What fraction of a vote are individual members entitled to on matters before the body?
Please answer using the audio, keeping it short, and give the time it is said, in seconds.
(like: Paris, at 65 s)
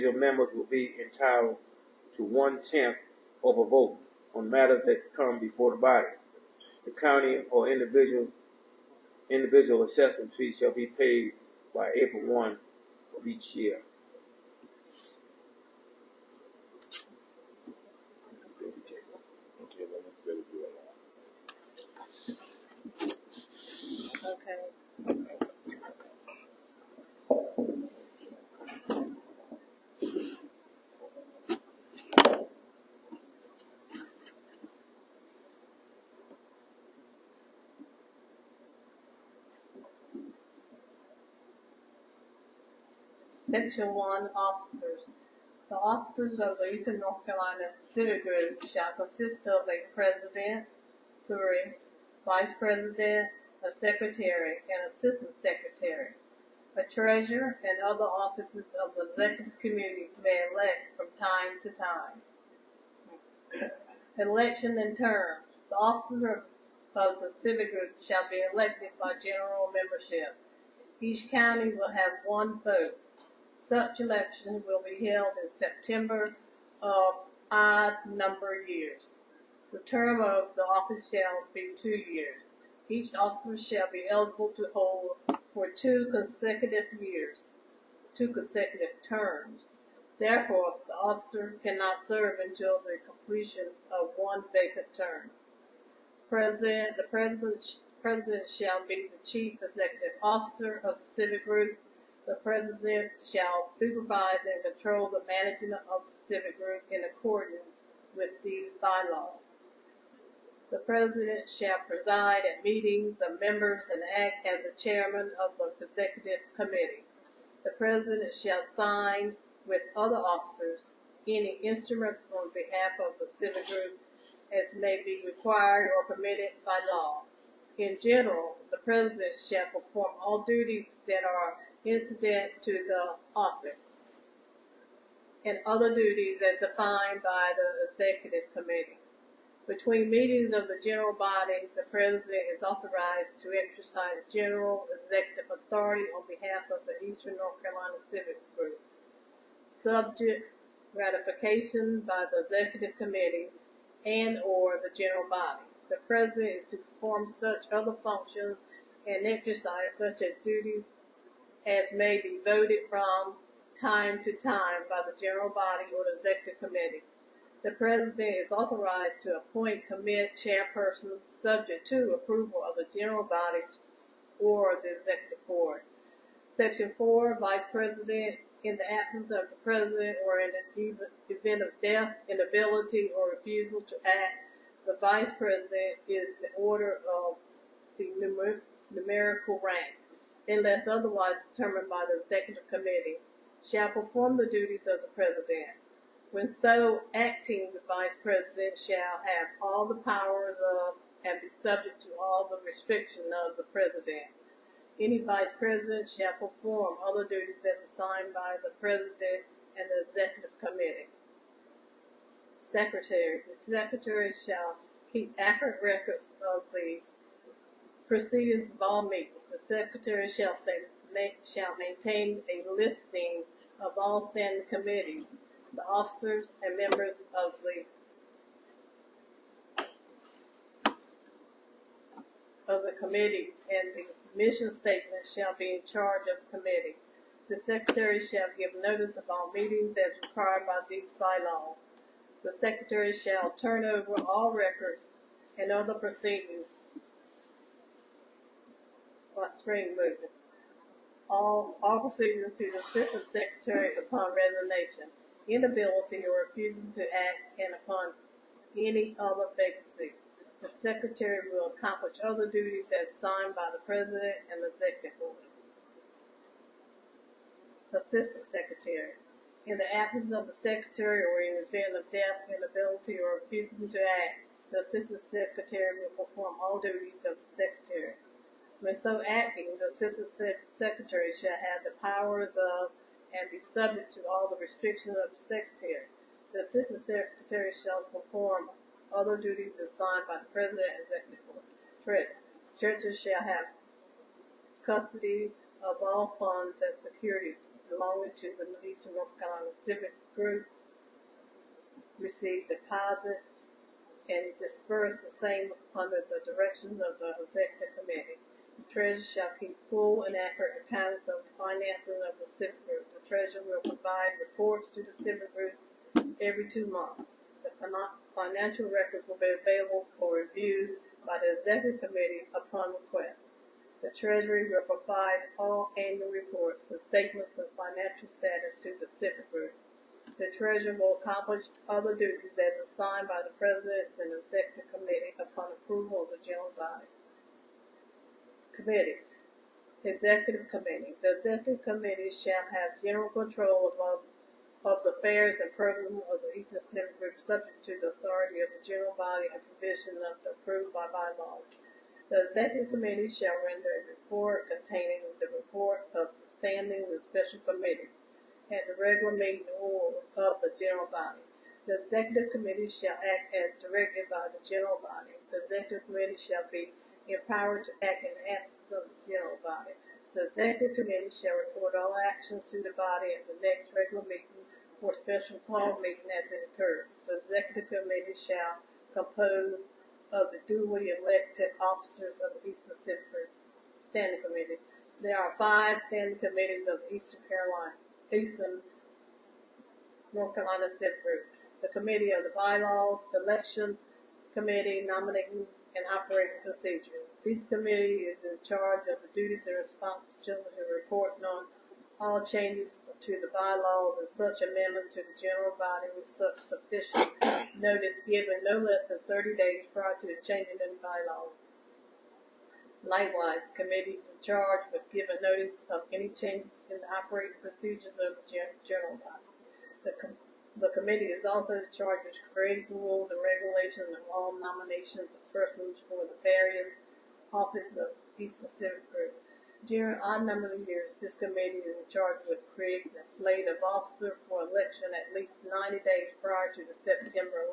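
One-tenth, at 2 s.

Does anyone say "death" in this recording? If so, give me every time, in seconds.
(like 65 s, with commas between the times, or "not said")
181 s, 272 s.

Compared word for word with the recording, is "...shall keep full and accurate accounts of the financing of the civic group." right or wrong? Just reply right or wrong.
right.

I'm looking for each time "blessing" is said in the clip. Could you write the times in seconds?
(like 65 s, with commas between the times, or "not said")
not said.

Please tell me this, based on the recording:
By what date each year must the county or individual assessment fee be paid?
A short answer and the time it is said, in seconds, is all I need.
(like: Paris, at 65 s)
April 1, at 11 s.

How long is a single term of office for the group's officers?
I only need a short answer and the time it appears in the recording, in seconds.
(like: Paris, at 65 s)
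2 years, at 81 s.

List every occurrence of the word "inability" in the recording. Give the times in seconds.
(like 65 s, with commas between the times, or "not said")
182 s, 255 s, 272 s.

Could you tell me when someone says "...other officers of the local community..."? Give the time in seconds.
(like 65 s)
57 s.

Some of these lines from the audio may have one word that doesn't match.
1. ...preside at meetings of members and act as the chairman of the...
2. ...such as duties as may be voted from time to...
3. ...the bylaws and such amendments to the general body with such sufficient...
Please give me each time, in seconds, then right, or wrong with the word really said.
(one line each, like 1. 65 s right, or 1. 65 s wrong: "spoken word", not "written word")
1. 111 s right
2. 159 s right
3. 403 s right.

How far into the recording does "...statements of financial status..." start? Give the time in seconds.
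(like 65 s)
326 s.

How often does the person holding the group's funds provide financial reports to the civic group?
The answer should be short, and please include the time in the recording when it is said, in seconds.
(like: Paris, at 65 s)
Every 2 months, at 316 s.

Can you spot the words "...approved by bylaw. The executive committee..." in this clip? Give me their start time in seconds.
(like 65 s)
350 s.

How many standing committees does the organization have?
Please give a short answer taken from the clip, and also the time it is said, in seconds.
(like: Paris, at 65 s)
5, at 385 s.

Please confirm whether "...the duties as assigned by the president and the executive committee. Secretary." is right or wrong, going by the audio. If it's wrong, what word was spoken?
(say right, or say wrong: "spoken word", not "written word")
right.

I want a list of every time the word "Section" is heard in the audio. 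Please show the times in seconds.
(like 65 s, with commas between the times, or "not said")
43 s, 176 s.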